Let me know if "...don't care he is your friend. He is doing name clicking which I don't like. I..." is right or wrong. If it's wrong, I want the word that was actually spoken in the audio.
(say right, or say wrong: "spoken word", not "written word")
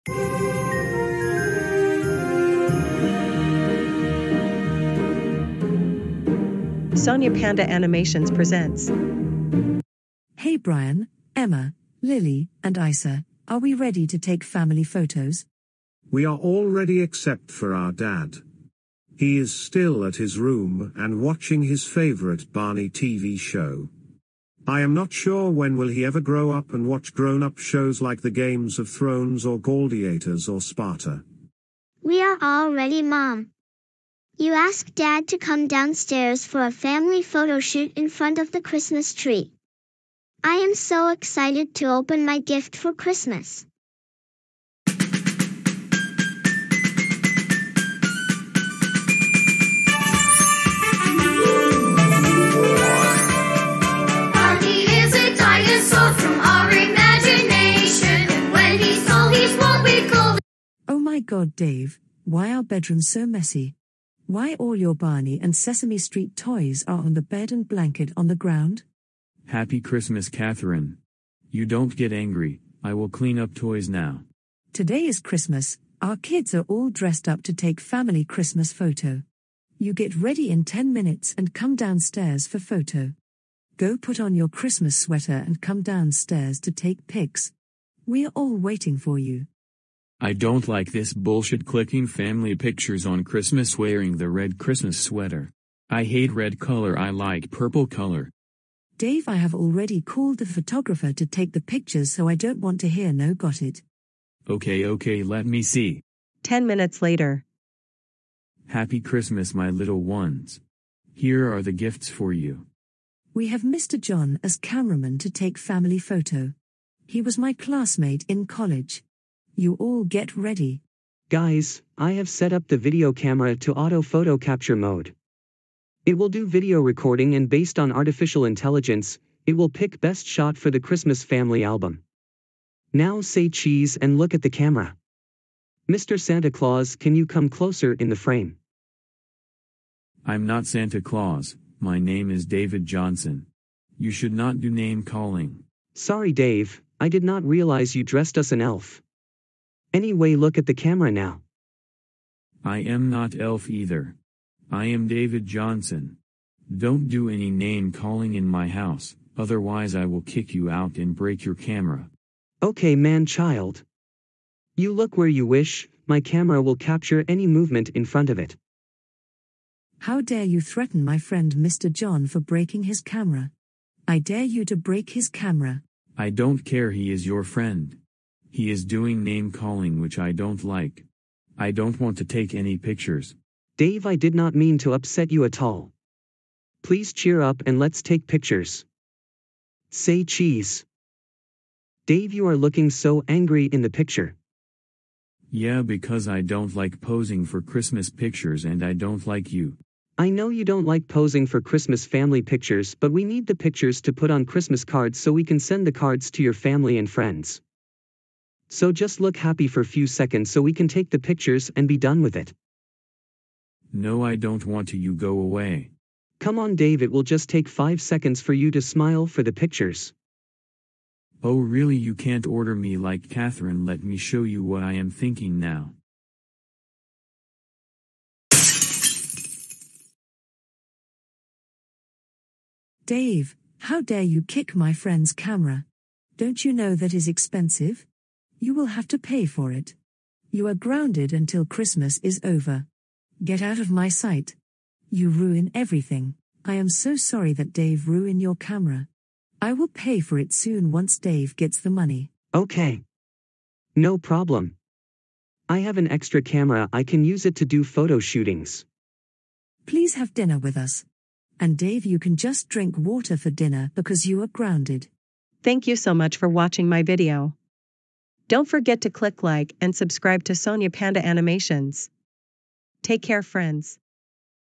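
wrong: "calling", not "clicking".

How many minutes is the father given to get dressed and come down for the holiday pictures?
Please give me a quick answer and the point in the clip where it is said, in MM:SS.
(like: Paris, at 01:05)
10, at 01:20.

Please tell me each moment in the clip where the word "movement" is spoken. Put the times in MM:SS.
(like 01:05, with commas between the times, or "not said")
02:47.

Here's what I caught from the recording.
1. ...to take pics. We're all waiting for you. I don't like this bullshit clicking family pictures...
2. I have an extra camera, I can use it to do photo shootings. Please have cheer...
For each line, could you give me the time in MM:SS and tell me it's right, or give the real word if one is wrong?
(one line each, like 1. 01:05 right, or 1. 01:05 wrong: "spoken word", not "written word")
1. 01:26 right
2. 04:15 wrong: "dinner", not "cheer".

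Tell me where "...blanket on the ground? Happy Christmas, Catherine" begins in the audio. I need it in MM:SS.
01:07.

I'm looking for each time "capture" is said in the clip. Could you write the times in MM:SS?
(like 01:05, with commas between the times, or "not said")
02:04, 02:46.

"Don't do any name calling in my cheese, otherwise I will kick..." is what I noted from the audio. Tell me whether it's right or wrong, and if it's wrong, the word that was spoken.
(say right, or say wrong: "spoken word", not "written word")
wrong: "house", not "cheese".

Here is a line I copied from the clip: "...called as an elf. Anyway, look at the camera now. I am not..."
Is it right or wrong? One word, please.
wrong.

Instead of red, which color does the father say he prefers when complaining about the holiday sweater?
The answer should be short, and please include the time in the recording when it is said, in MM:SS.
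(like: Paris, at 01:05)
Purple, at 01:37.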